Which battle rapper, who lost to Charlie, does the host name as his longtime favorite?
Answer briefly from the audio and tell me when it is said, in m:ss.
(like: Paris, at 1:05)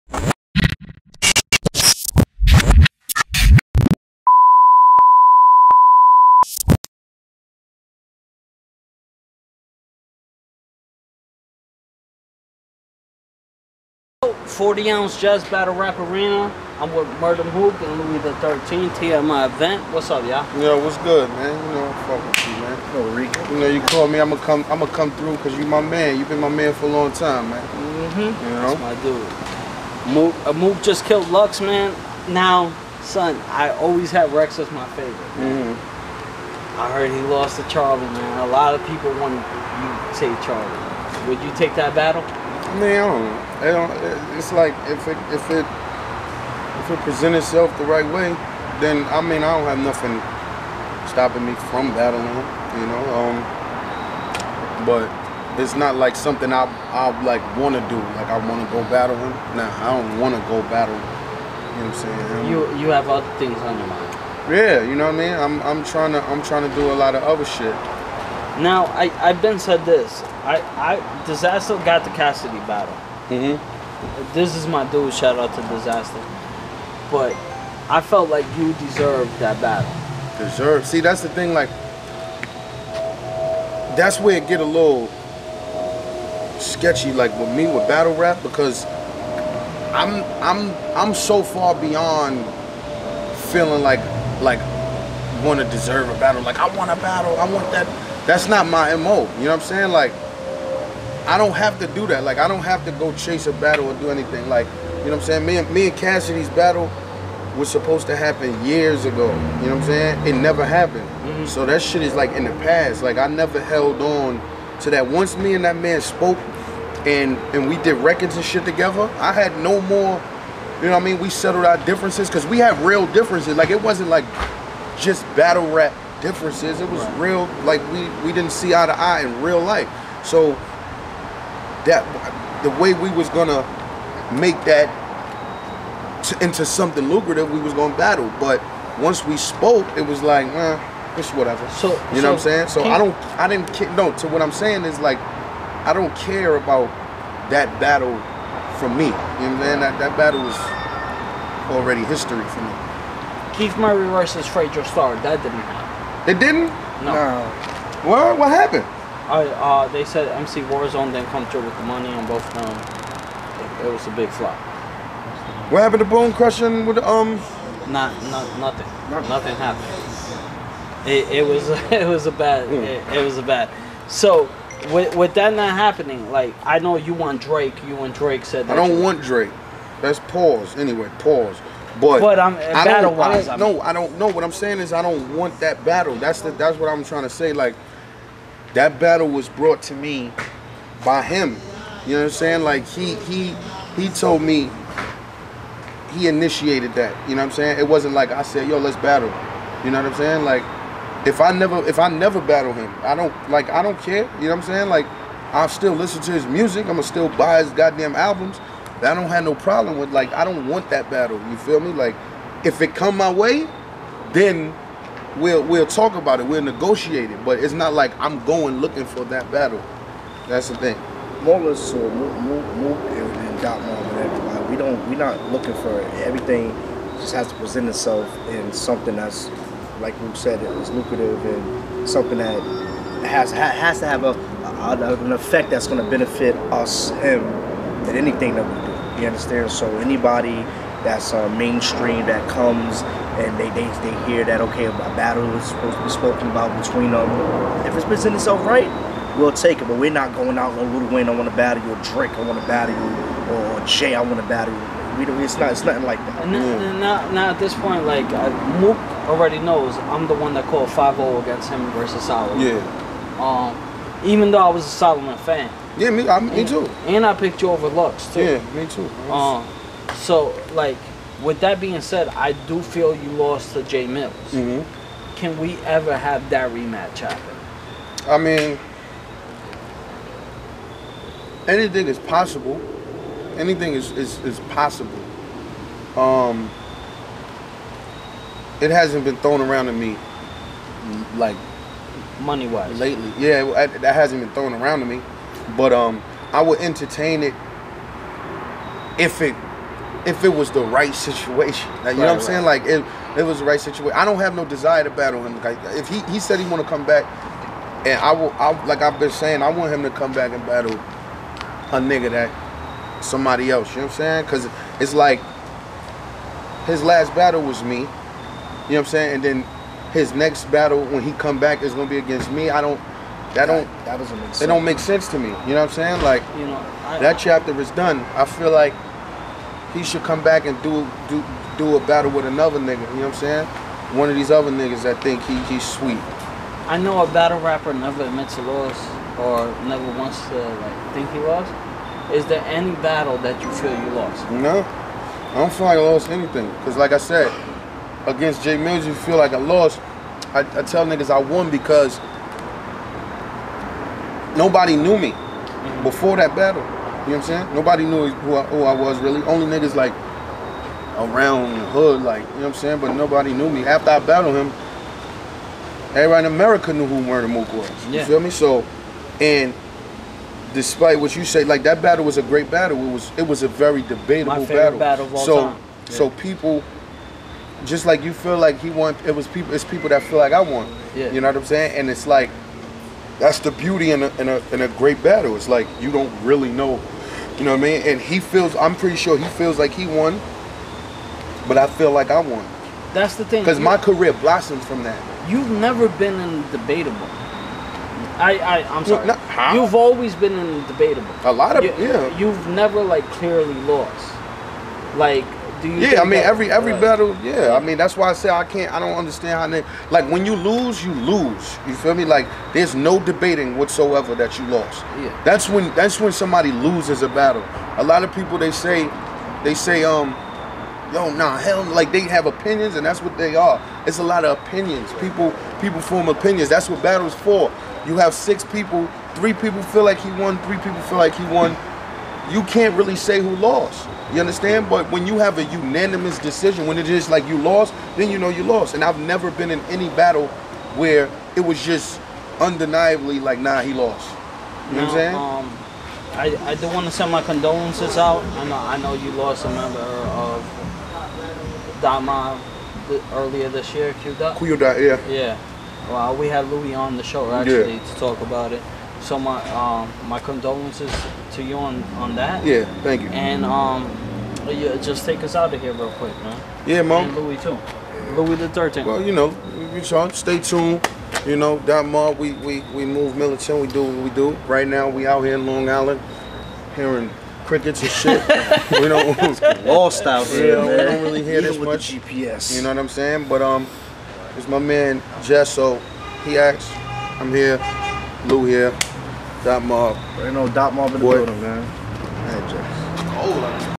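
Rex, at 0:34.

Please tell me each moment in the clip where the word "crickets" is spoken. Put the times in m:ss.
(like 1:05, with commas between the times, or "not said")
7:57.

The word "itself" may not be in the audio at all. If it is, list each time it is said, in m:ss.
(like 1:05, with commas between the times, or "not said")
0:47, 3:47, 4:08.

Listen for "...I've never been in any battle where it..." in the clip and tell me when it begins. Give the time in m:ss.
7:19.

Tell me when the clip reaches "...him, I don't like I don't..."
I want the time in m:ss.
3:22.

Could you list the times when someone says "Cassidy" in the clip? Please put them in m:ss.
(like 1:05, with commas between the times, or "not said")
1:12, 1:45.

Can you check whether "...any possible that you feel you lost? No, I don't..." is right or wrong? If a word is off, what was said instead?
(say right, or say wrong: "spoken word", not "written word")
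wrong: "battle", not "possible".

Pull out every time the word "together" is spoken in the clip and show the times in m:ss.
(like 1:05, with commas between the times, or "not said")
1:58.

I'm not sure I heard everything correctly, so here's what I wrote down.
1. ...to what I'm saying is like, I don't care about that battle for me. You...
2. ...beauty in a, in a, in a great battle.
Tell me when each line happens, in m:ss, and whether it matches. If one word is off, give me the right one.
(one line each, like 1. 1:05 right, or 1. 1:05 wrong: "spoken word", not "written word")
1. 2:24 right
2. 6:23 right.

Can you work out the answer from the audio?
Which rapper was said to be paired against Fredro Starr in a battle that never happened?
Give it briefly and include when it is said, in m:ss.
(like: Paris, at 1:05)
Keith Murray, at 2:33.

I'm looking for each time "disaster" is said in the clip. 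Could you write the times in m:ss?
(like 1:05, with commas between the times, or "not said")
1:11, 1:15.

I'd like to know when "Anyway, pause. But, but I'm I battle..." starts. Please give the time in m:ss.
3:00.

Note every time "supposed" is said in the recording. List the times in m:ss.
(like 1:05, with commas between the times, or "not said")
1:47, 4:05.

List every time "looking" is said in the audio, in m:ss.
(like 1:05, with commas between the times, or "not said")
3:38, 3:45.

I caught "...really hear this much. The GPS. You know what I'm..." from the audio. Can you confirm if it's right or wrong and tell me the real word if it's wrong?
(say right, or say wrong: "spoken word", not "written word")
right.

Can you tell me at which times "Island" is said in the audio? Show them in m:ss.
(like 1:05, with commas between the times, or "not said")
7:55.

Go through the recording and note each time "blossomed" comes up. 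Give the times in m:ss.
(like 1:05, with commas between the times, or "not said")
6:34.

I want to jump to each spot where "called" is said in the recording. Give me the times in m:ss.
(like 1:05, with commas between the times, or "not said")
0:23, 4:20.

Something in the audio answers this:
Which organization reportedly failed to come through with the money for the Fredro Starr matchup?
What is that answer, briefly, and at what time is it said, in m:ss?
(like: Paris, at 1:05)
MC Warzone, at 2:40.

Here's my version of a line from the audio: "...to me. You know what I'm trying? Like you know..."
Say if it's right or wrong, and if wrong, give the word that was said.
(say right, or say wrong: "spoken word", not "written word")
wrong: "saying", not "trying".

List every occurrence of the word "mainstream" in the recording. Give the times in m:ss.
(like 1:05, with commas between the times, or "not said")
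4:01.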